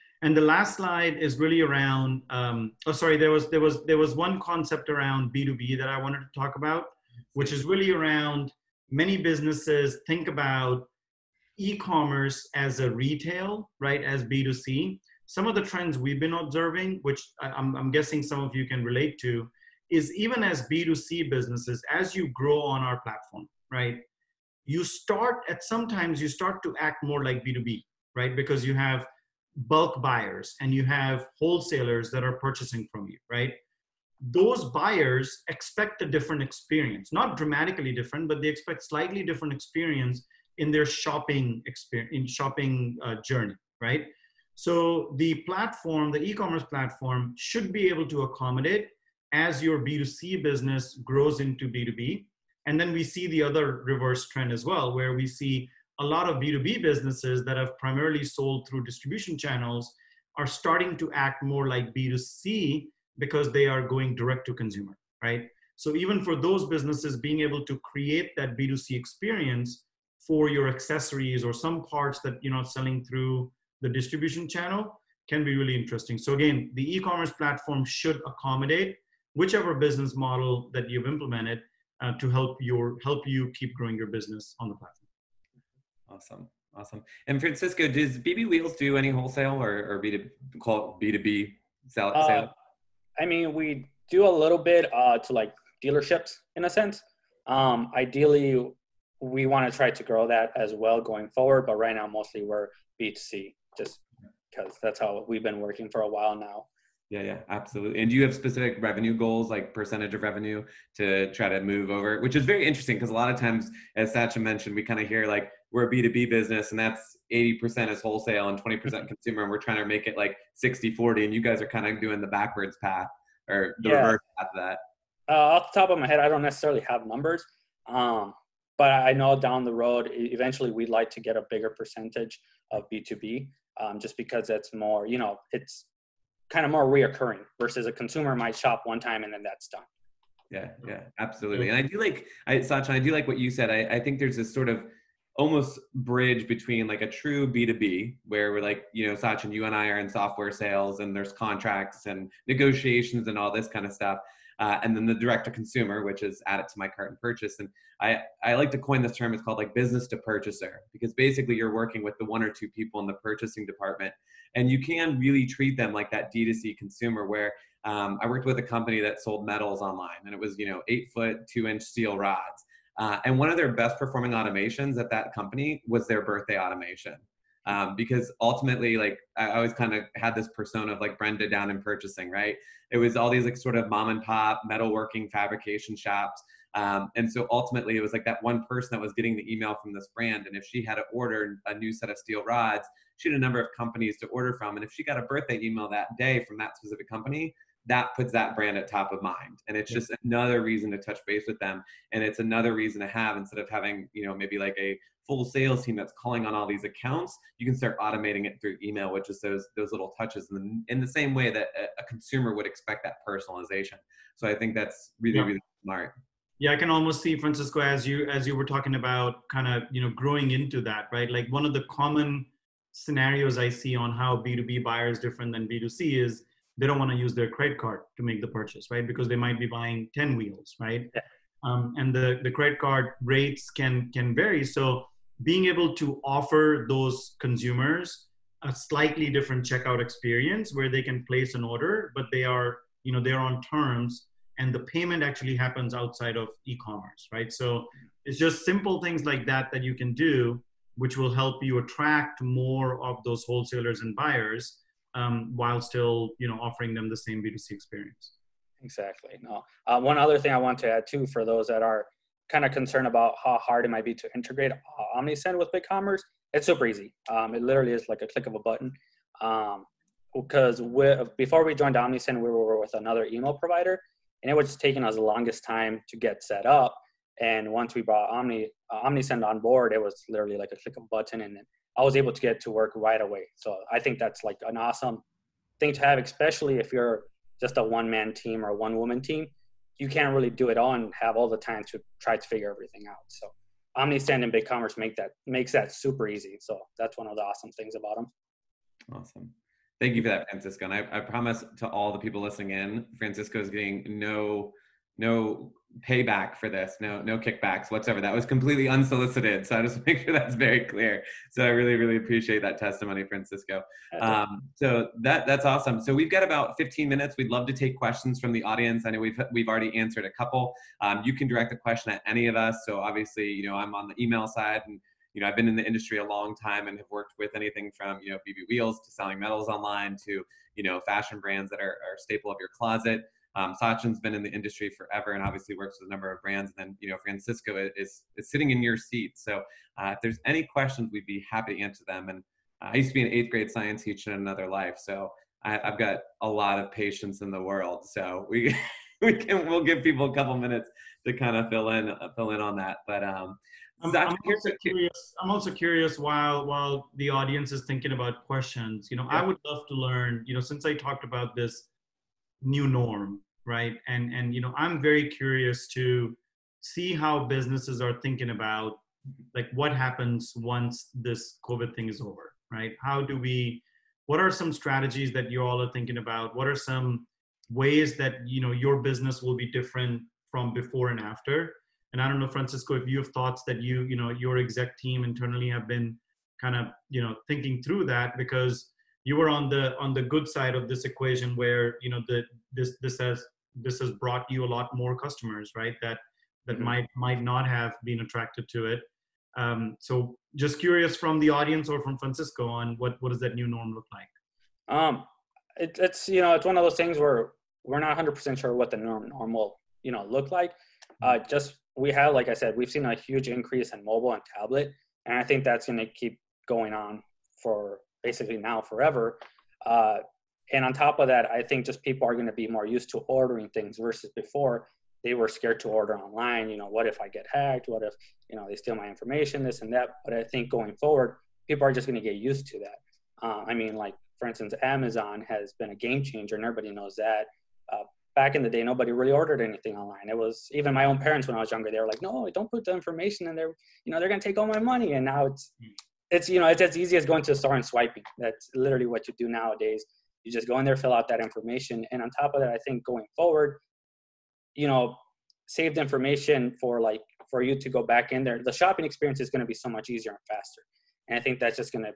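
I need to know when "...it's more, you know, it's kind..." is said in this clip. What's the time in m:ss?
2:14.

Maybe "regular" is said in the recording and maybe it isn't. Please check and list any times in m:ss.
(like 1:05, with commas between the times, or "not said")
not said.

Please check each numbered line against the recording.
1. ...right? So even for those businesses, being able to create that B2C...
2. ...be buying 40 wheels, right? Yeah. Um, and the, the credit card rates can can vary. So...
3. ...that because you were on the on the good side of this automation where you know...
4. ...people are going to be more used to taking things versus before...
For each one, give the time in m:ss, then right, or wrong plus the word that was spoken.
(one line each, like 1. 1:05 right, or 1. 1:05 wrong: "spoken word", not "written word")
1. 1:05 right
2. 3:49 wrong: "10", not "40"
3. 6:28 wrong: "equation", not "automation"
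4. 7:02 wrong: "ordering", not "taking".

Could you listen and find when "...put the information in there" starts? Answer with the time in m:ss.
7:22.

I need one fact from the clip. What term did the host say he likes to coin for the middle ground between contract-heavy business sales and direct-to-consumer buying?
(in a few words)
business to purchaser.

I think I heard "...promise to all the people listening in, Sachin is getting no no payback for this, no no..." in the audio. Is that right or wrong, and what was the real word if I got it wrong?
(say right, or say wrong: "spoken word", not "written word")
wrong: "Francisco", not "Sachin".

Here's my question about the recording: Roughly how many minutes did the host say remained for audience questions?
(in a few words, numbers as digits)
15.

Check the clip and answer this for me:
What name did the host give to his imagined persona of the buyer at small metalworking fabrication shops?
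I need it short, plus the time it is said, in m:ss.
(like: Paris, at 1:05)
Brenda, at 3:01.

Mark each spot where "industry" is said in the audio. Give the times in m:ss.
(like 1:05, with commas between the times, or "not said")
5:25, 5:34.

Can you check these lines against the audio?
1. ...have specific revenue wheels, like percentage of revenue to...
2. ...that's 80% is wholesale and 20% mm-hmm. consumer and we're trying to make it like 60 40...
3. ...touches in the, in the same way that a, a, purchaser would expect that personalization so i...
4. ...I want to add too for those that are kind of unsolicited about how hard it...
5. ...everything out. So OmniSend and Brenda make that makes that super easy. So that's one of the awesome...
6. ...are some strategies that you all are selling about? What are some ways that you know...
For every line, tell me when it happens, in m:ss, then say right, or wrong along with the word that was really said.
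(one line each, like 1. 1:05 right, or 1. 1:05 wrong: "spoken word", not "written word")
1. 1:48 wrong: "goals", not "wheels"
2. 1:56 right
3. 3:30 wrong: "consumer", not "purchaser"
4. 4:20 wrong: "concerned", not "unsolicited"
5. 4:52 wrong: "BigCommerce", not "Brenda"
6. 6:14 wrong: "thinking", not "selling".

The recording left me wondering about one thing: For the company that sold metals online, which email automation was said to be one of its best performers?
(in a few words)
birthday automation.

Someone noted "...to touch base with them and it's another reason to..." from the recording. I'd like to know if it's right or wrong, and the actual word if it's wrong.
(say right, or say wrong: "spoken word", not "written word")
right.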